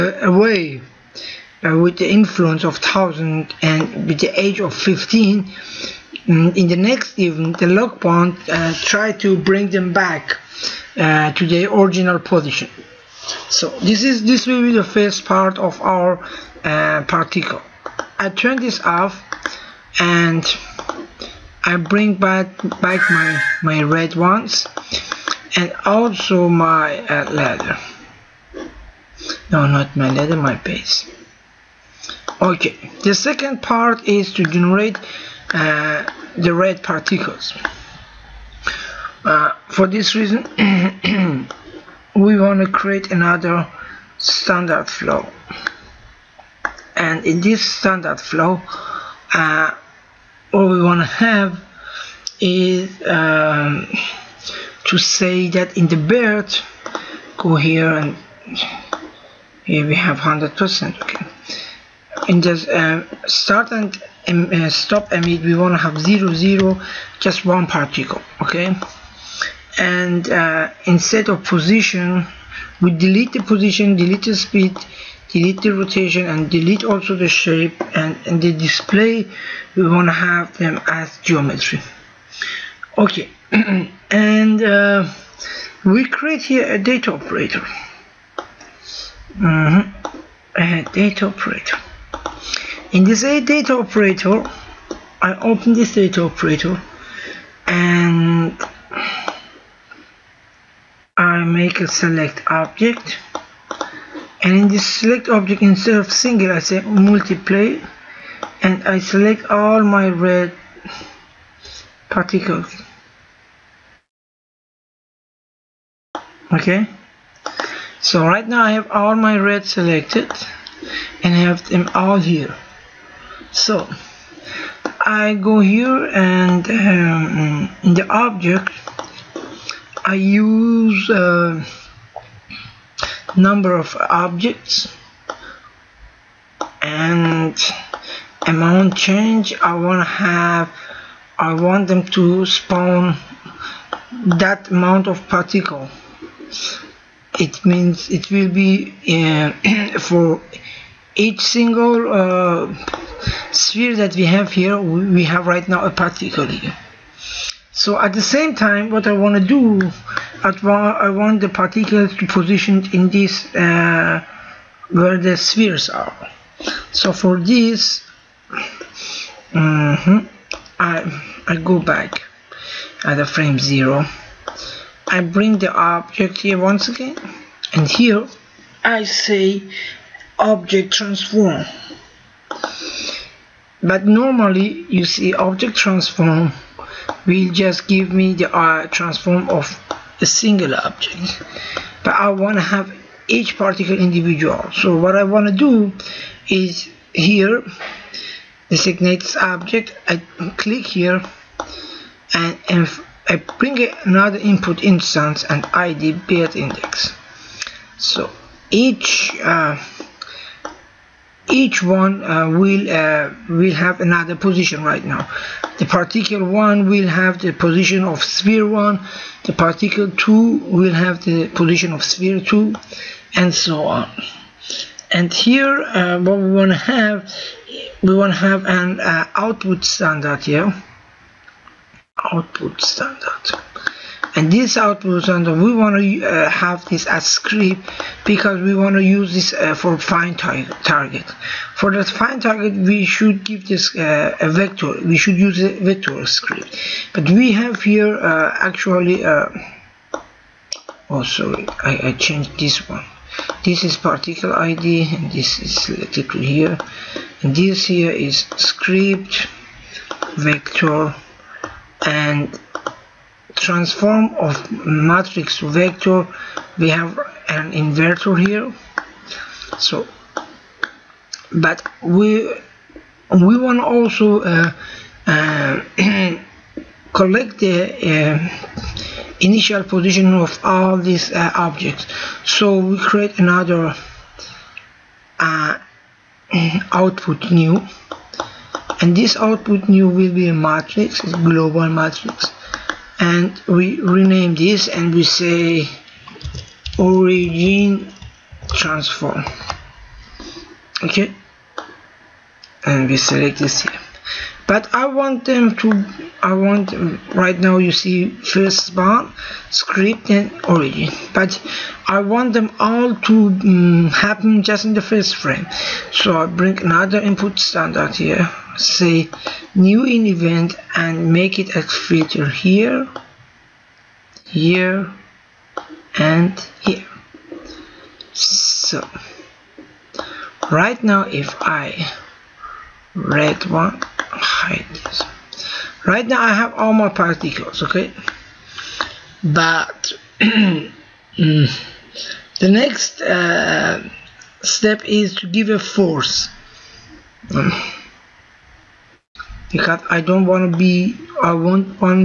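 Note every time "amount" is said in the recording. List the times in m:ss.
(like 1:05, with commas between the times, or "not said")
2:18, 2:24.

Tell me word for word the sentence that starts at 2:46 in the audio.
So for this, mm-hmm, I I go back at the frame zero.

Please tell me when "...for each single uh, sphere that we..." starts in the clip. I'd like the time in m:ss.
2:29.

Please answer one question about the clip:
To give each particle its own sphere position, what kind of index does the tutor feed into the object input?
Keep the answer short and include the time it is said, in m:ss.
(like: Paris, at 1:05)
build index, at 3:26.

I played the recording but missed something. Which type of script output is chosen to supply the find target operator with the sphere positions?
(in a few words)
script vector.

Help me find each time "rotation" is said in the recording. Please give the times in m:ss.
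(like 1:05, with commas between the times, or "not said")
1:15.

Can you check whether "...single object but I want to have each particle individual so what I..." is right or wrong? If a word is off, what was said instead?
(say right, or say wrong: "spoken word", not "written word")
right.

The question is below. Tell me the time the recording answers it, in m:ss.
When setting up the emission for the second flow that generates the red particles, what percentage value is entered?
1:00.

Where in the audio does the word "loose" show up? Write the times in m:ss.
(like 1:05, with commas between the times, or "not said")
not said.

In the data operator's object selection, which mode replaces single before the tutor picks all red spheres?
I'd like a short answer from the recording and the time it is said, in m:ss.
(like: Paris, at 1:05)
multiply, at 1:46.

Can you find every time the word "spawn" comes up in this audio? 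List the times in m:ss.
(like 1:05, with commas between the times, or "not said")
2:22, 5:08.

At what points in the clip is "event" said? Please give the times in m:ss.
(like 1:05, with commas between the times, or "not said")
0:07, 5:20.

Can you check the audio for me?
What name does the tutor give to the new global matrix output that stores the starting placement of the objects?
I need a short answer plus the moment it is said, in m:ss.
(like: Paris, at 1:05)
origin transform, at 4:56.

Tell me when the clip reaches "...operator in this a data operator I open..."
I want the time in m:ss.
1:31.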